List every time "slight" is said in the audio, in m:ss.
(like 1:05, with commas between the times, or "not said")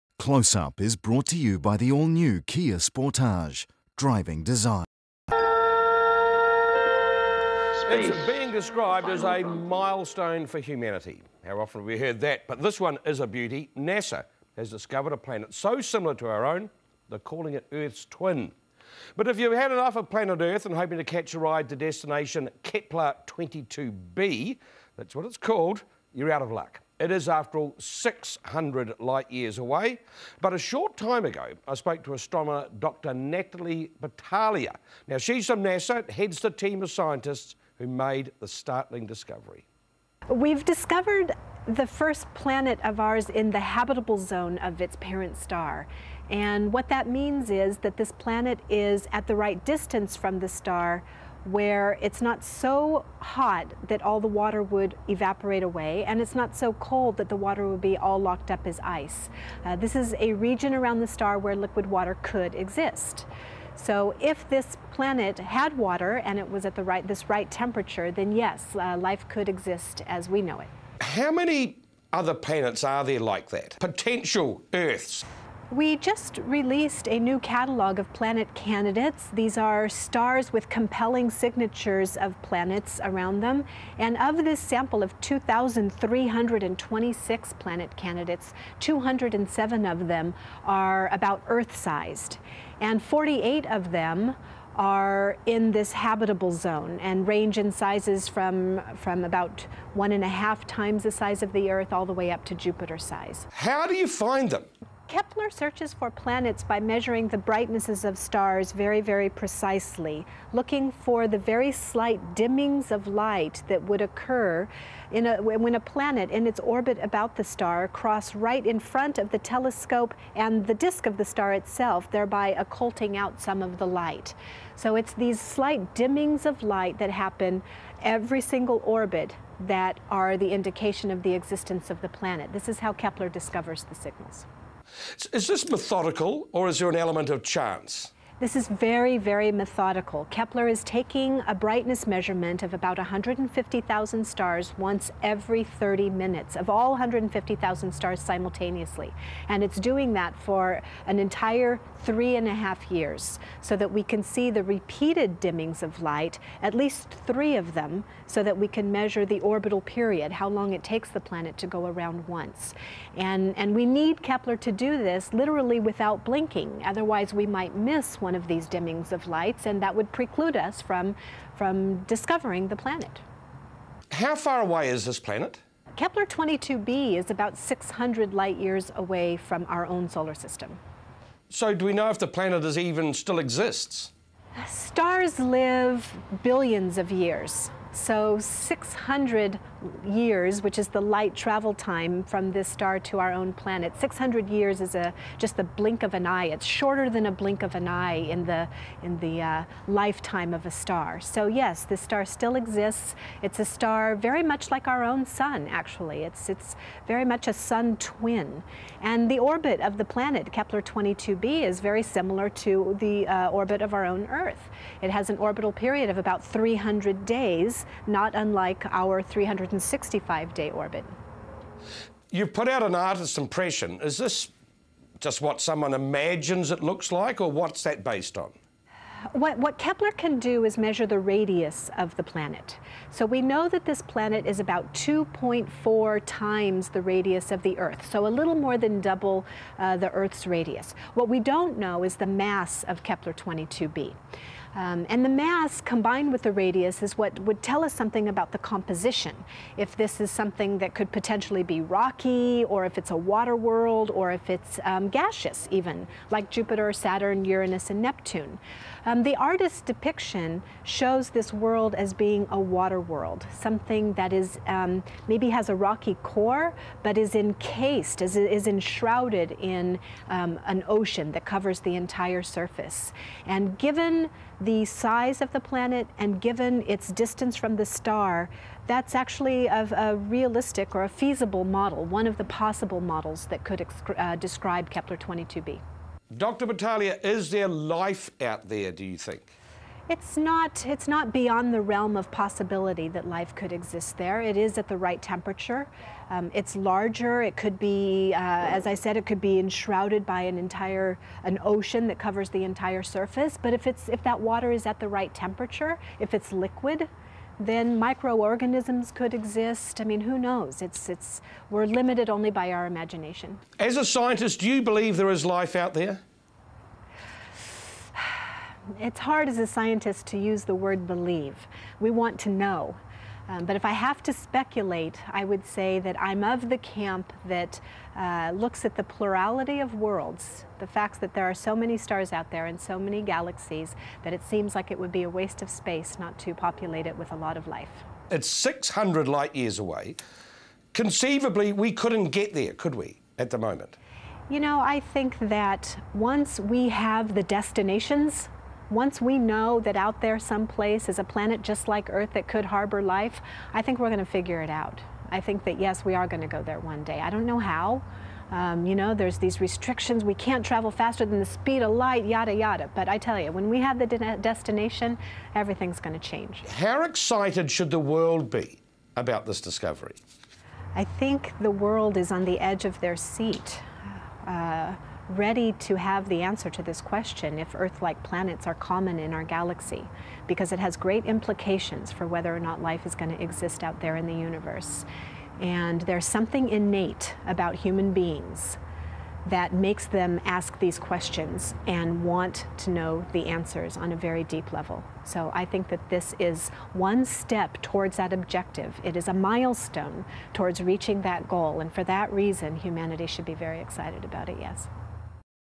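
1:51, 2:05.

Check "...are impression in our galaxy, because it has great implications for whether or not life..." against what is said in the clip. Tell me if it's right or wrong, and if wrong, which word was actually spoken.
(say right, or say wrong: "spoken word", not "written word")
wrong: "common", not "impression".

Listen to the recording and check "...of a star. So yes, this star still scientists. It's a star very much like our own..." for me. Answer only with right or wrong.
wrong.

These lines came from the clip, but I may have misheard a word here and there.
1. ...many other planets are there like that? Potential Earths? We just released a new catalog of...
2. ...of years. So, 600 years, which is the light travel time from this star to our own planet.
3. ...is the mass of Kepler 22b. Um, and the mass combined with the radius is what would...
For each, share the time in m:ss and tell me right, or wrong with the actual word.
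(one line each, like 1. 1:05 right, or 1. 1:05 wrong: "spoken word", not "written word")
1. 1:11 right
2. 3:06 right
3. 4:02 right.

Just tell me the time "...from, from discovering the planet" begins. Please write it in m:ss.
2:50.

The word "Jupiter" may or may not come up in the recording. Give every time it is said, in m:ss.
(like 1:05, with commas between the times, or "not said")
1:42, 4:16.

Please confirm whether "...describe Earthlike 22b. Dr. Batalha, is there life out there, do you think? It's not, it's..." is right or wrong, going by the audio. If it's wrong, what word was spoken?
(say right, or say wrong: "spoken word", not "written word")
wrong: "Kepler", not "Earthlike".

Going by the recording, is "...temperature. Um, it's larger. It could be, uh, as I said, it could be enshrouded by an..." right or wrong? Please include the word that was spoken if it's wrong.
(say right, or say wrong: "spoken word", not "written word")
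right.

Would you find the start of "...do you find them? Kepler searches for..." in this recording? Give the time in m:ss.
1:43.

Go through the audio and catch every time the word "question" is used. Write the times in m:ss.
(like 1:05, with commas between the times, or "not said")
6:17, 6:30.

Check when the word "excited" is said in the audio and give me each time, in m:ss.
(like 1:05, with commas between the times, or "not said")
6:07, 6:43.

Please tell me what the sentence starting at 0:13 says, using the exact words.
NASA has discovered a planet so similar to our own, they're calling it Earth's twin.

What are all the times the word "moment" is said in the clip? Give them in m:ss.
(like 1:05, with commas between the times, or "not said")
5:43.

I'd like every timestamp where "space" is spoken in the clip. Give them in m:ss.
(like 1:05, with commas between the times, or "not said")
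5:35.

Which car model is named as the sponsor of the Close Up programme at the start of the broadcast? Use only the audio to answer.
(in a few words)
Kia Sportage.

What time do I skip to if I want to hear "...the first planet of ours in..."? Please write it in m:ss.
0:41.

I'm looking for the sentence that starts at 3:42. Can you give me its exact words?
You put out an artist's impression.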